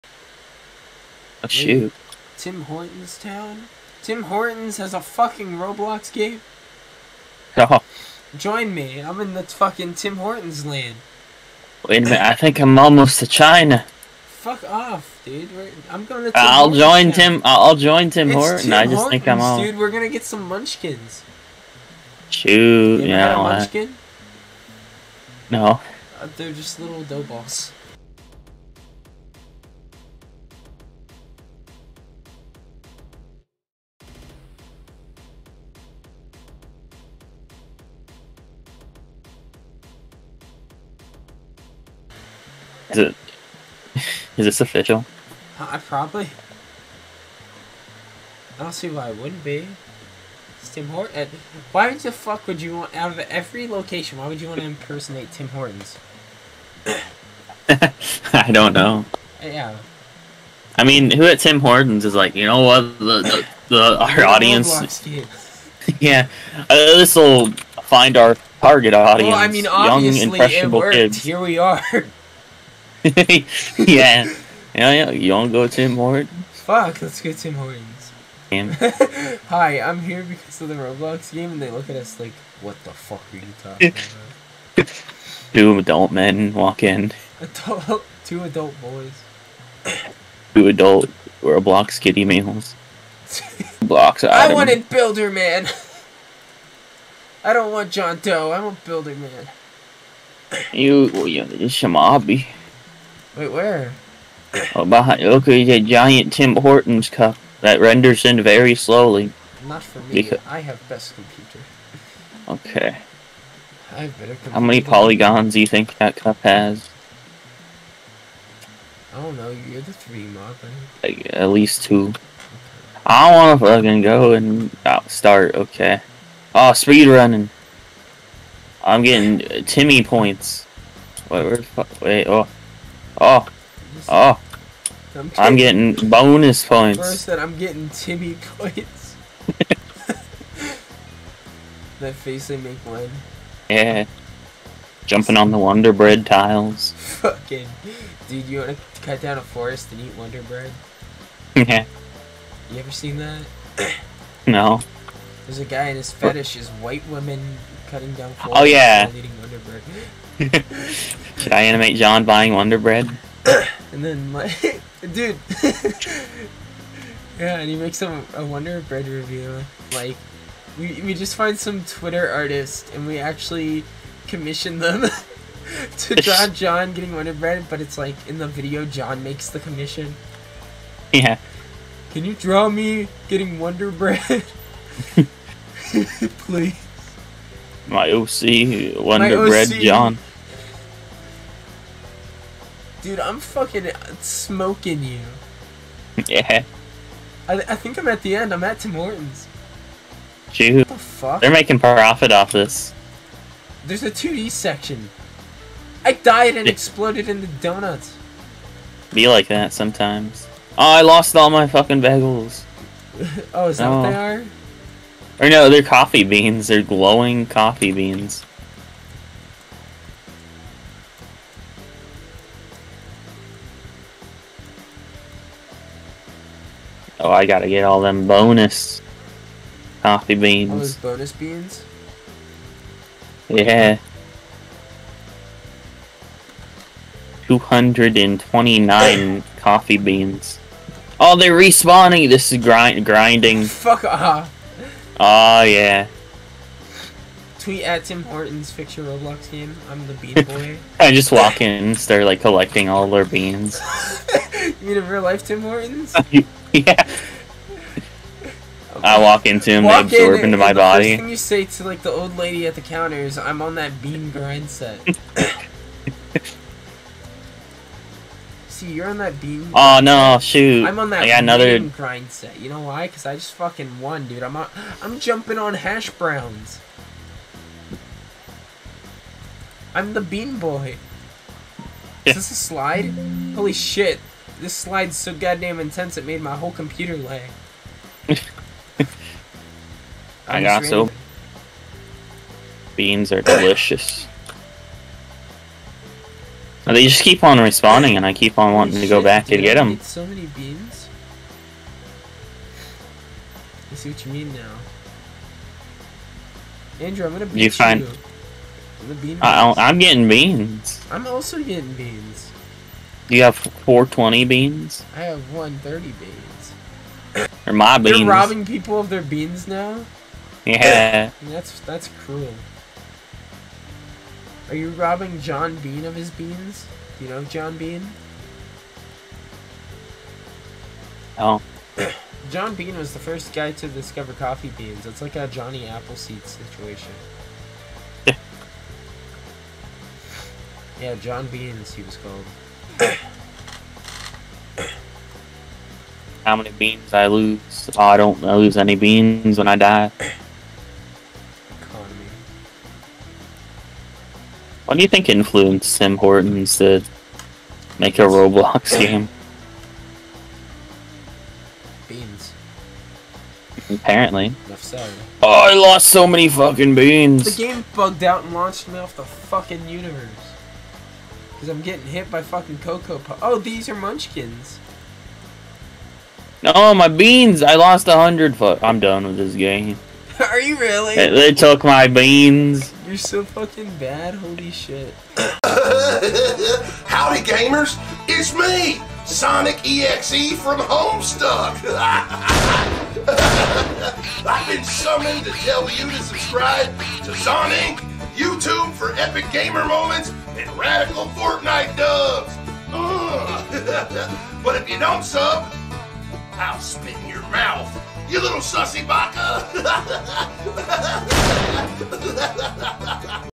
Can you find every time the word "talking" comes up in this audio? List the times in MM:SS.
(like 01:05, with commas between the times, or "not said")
01:23.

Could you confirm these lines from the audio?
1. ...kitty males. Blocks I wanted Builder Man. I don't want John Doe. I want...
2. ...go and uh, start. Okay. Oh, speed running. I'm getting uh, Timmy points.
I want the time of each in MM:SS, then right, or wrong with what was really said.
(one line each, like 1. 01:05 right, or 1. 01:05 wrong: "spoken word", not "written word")
1. 01:31 right
2. 02:04 right.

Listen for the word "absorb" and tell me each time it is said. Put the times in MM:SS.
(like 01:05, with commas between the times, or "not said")
04:20.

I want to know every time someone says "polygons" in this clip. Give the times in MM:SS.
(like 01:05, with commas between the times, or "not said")
01:54.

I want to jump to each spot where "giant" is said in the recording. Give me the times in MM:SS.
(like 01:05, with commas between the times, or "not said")
01:45.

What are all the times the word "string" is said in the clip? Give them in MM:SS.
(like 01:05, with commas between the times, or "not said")
not said.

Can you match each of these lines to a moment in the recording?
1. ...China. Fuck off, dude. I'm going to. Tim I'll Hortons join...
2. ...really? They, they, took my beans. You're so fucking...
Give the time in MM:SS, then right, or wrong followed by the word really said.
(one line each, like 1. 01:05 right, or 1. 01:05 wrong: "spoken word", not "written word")
1. 00:13 right
2. 06:20 right.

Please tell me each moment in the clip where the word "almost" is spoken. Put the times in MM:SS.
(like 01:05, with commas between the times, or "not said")
00:12.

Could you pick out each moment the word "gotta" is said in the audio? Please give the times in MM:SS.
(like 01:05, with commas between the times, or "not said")
03:47.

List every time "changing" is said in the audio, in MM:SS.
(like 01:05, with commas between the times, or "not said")
not said.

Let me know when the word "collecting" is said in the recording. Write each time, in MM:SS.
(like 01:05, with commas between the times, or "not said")
04:12.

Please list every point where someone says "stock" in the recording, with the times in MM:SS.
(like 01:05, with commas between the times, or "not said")
not said.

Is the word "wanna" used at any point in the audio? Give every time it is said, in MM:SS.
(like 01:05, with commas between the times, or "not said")
02:28.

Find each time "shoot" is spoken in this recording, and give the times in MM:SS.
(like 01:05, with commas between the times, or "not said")
00:01, 00:22, 04:30.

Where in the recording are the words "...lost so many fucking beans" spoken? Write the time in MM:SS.
06:05.